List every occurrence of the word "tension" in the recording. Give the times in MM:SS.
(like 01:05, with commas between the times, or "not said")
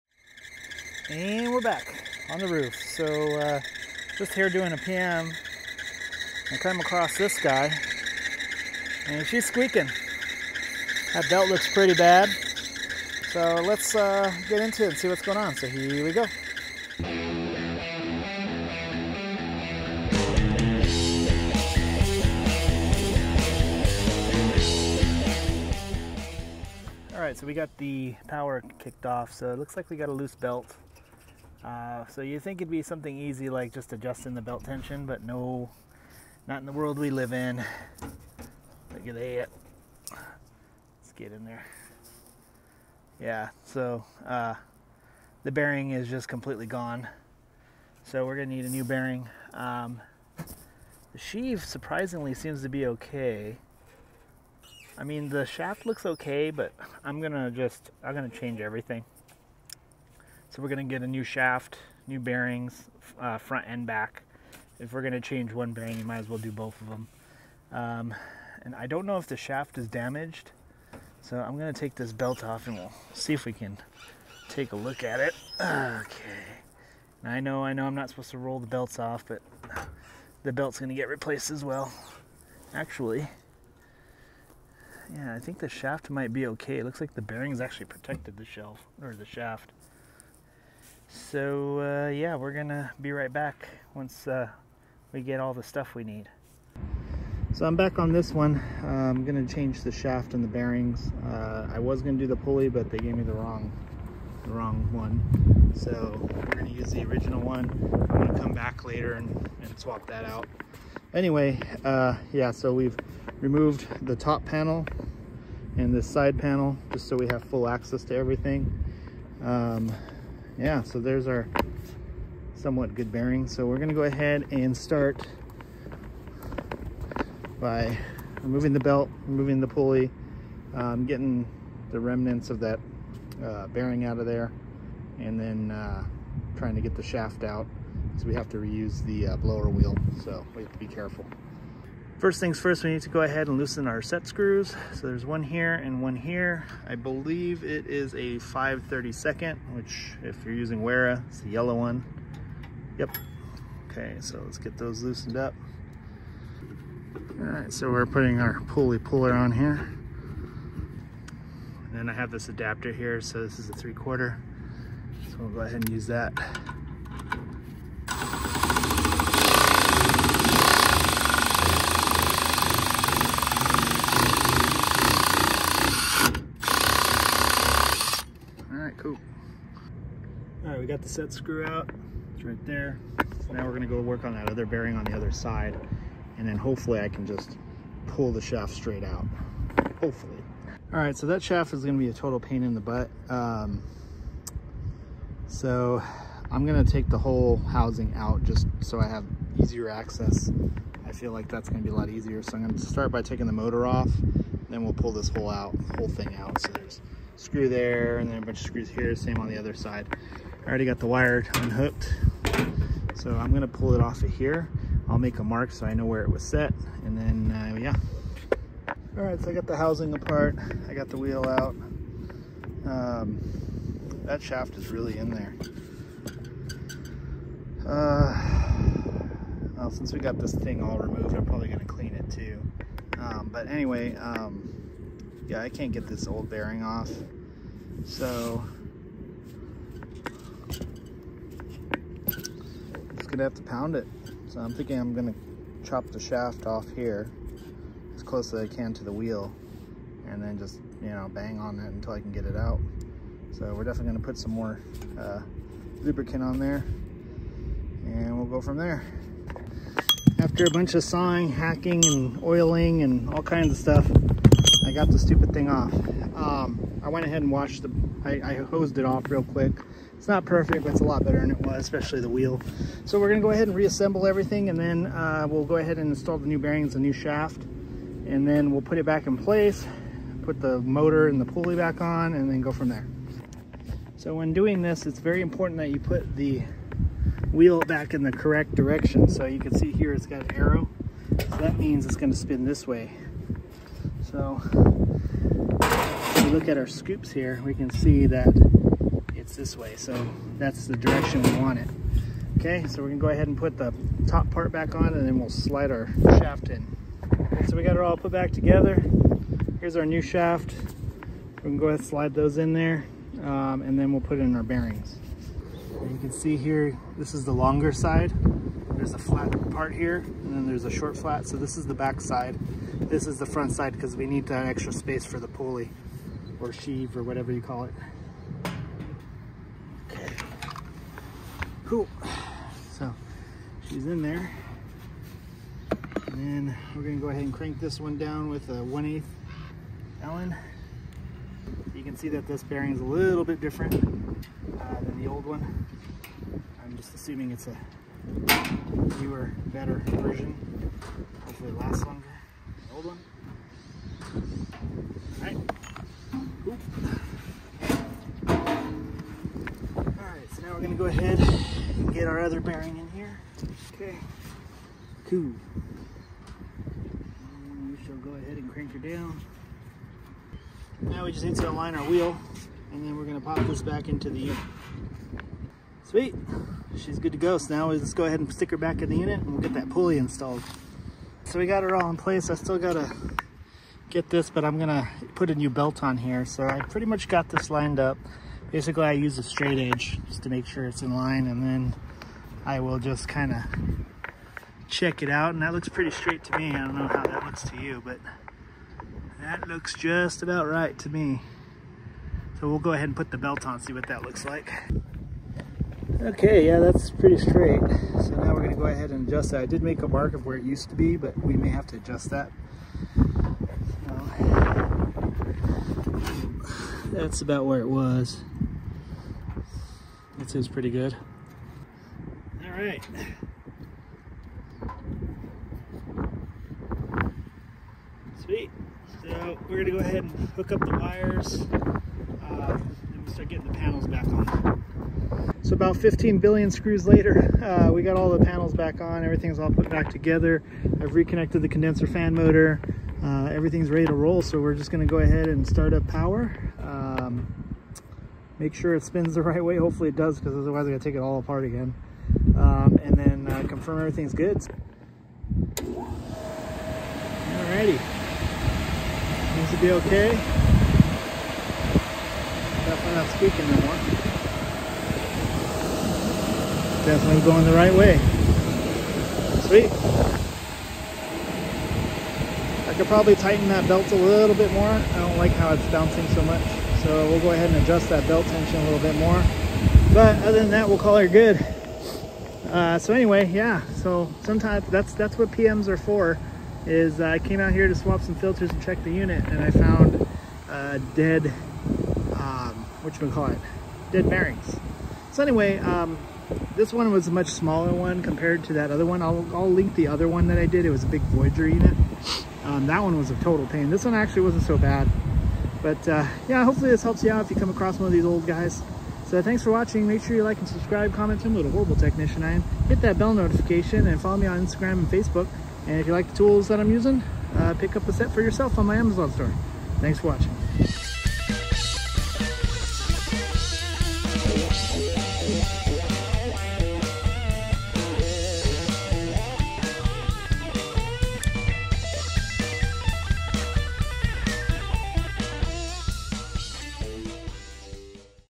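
00:34, 07:58.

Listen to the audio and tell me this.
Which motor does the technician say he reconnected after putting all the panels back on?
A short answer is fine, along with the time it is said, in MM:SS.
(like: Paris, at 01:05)
Condenser fan motor, at 07:21.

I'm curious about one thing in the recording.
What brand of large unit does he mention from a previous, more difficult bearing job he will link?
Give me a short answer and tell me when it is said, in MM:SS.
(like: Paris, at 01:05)
Voyager, at 08:21.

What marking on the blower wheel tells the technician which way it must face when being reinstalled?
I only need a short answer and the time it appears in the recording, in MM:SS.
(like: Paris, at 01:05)
An arrow, at 04:50.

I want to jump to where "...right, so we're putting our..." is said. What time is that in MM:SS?
02:37.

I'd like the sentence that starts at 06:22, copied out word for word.
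I still gotta get this, but I'm gonna put a new belt on here.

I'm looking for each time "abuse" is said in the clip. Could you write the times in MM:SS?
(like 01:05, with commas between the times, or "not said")
not said.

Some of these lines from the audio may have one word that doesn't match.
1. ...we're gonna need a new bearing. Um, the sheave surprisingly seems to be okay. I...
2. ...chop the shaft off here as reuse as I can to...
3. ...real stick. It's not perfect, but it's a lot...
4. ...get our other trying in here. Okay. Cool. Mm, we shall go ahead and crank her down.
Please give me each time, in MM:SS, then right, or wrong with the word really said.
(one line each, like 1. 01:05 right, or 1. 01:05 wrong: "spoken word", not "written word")
1. 00:48 right
2. 04:05 wrong: "close", not "reuse"
3. 04:29 wrong: "quick", not "stick"
4. 06:02 wrong: "bearing", not "trying".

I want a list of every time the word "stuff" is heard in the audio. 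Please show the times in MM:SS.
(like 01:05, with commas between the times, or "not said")
01:35, 04:23.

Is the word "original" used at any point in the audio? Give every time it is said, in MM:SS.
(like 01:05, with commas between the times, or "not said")
01:47.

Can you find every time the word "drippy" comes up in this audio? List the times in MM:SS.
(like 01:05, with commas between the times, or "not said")
not said.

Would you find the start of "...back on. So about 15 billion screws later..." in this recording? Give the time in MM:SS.
07:14.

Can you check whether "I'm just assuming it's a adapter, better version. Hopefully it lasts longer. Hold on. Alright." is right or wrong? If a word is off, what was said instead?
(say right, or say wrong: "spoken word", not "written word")
wrong: "newer", not "adapter".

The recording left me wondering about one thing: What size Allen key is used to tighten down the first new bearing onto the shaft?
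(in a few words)
1/8.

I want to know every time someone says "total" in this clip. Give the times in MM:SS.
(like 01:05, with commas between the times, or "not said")
03:12, 08:23.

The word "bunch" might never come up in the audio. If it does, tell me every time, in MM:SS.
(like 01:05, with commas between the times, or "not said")
03:28, 04:20.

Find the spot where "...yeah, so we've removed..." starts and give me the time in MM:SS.
01:52.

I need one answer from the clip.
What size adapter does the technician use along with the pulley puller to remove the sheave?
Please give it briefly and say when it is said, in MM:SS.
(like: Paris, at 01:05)
3/4, at 02:43.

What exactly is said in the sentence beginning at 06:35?
And that looks pretty straight to me.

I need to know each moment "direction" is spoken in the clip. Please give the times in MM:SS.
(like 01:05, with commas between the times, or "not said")
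04:48, 05:00.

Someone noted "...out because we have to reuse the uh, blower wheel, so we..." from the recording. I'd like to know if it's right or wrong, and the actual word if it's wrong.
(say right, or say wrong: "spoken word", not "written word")
right.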